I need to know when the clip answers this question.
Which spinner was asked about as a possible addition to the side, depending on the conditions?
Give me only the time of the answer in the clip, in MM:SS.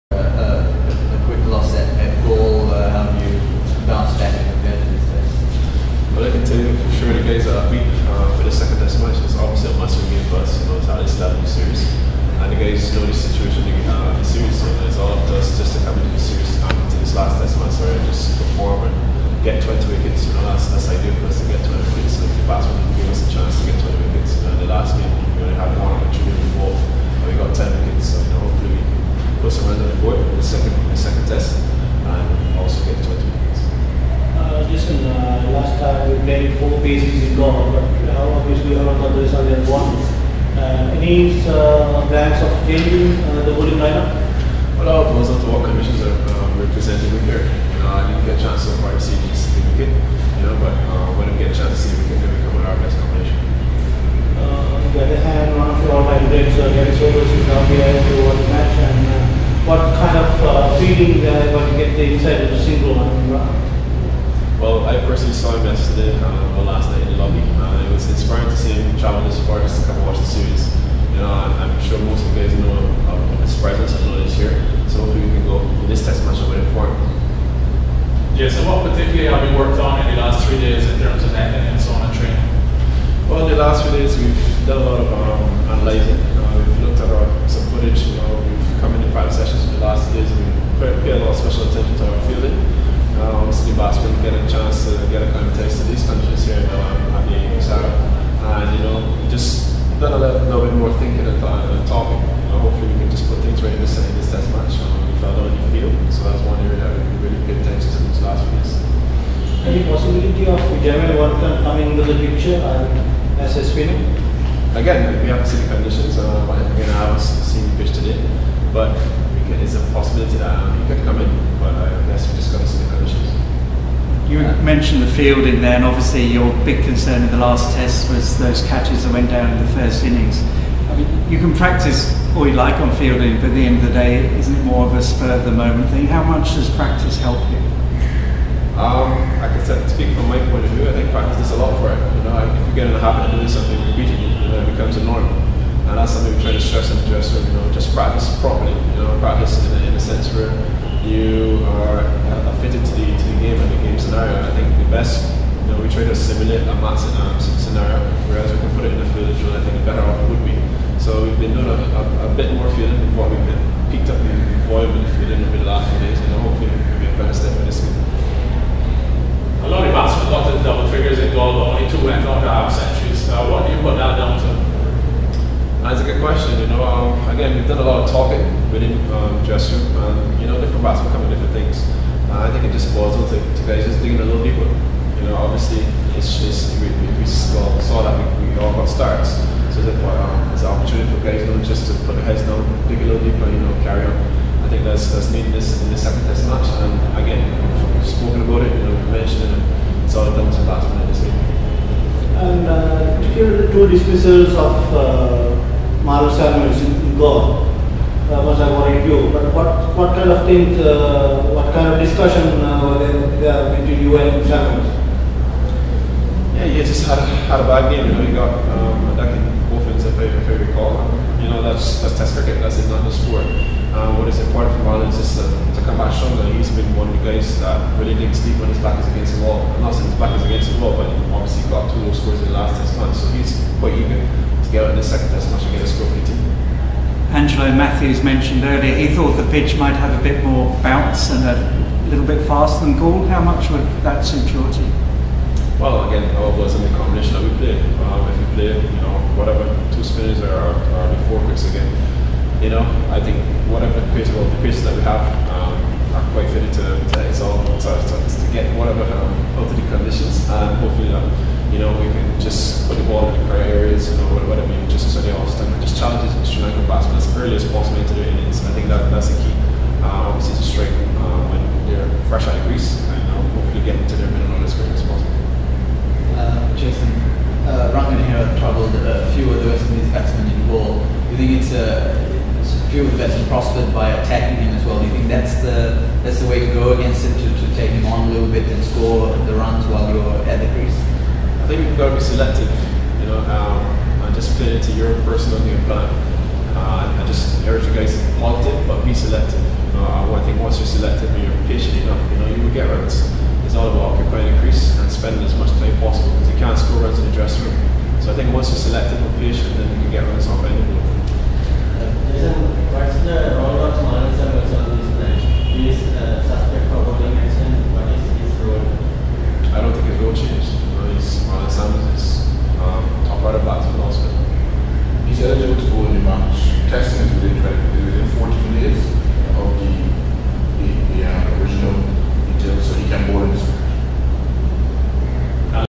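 01:50.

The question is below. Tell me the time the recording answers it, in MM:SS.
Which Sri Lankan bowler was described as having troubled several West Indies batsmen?
04:37.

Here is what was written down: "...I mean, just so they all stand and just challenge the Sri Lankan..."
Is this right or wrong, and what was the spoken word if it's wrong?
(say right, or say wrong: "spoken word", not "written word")
right.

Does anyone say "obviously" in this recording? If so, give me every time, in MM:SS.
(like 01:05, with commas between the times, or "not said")
01:33, 02:05, 03:05, 03:51, 04:30.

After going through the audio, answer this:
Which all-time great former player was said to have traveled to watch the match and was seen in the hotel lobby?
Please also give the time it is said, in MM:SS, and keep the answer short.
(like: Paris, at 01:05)
Garry Sobers, at 00:56.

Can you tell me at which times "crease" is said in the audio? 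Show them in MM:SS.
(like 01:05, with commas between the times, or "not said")
04:32, 04:50, 05:04.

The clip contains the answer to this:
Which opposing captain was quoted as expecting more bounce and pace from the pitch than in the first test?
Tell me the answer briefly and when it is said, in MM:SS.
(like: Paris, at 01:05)
Angelo Mathews, at 03:57.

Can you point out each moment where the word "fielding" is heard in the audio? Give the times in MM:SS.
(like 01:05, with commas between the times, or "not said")
01:32, 02:05, 02:12.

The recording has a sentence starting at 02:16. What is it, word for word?
How much does practice help practice this a lot for it.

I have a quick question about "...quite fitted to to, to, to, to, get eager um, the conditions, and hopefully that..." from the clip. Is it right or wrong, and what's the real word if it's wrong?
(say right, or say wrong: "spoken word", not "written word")
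wrong: "whatever", not "eager".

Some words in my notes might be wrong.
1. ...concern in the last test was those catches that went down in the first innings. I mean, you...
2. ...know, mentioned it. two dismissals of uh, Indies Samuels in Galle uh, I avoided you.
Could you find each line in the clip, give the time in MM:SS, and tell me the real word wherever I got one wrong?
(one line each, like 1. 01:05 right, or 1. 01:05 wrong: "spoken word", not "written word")
1. 02:06 right
2. 03:18 wrong: "Marlon", not "Indies".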